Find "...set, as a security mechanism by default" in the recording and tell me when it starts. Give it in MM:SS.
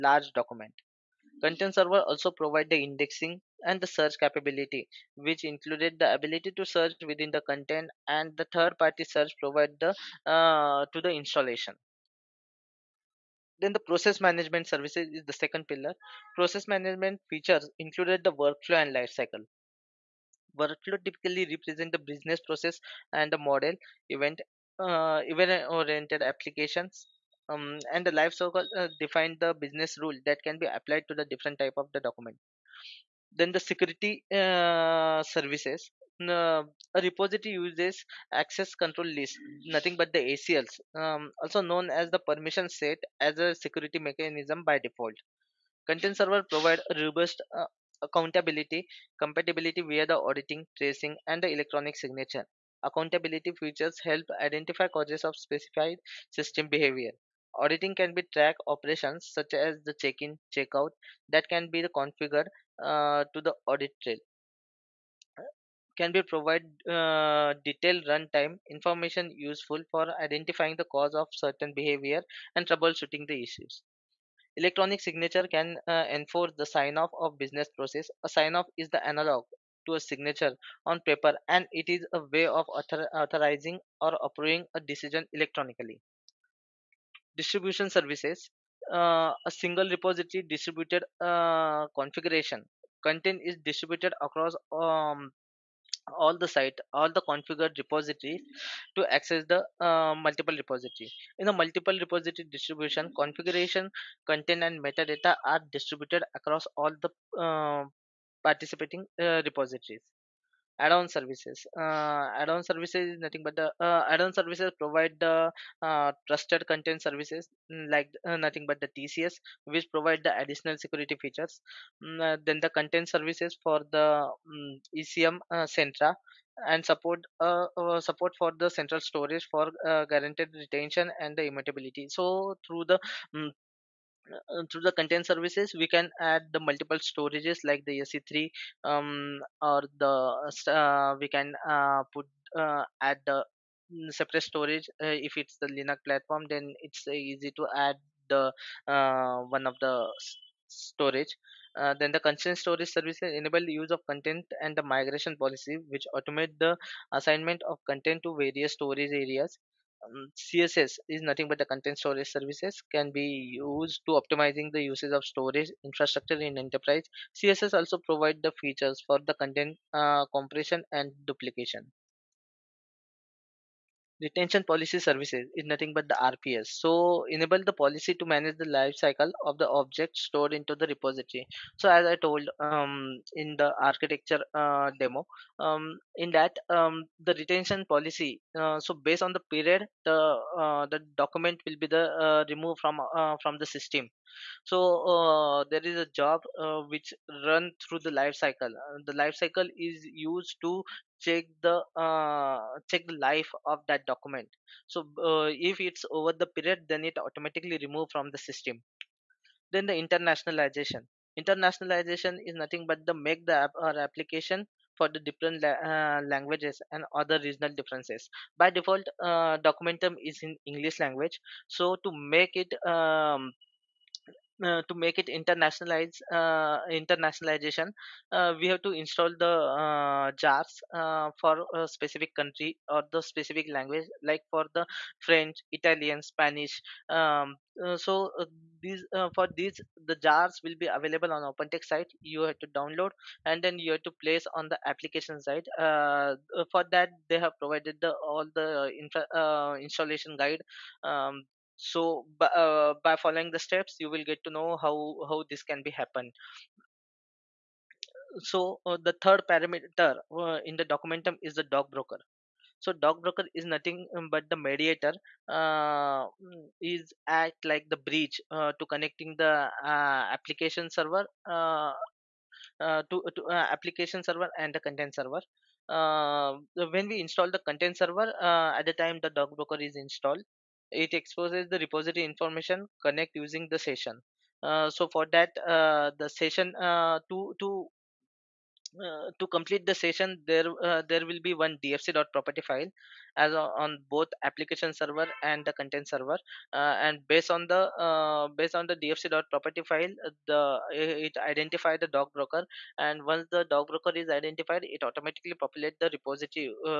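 00:42.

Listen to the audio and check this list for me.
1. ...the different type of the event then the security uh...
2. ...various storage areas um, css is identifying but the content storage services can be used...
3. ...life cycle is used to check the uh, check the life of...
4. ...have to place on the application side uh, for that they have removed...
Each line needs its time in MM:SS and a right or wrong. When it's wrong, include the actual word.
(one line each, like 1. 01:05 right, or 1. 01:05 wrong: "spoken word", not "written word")
1. 00:31 wrong: "document", not "event"
2. 02:38 wrong: "nothing", not "identifying"
3. 03:19 right
4. 04:03 wrong: "provided", not "removed".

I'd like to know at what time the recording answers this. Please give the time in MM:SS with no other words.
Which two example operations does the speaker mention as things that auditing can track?
01:00.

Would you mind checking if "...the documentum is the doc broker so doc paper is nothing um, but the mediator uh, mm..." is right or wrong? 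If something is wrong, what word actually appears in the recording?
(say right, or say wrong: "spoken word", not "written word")
wrong: "broker", not "paper".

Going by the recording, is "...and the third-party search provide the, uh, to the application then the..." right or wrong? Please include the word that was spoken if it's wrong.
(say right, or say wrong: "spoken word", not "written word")
wrong: "installation", not "application".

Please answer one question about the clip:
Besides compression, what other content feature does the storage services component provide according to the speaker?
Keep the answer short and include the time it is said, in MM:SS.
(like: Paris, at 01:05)
duplication, at 02:51.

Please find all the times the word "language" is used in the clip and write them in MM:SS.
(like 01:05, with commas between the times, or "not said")
03:36, 03:41, 03:53.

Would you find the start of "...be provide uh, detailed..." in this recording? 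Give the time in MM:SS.
01:06.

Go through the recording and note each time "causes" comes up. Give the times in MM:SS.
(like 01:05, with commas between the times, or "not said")
00:54, 01:10.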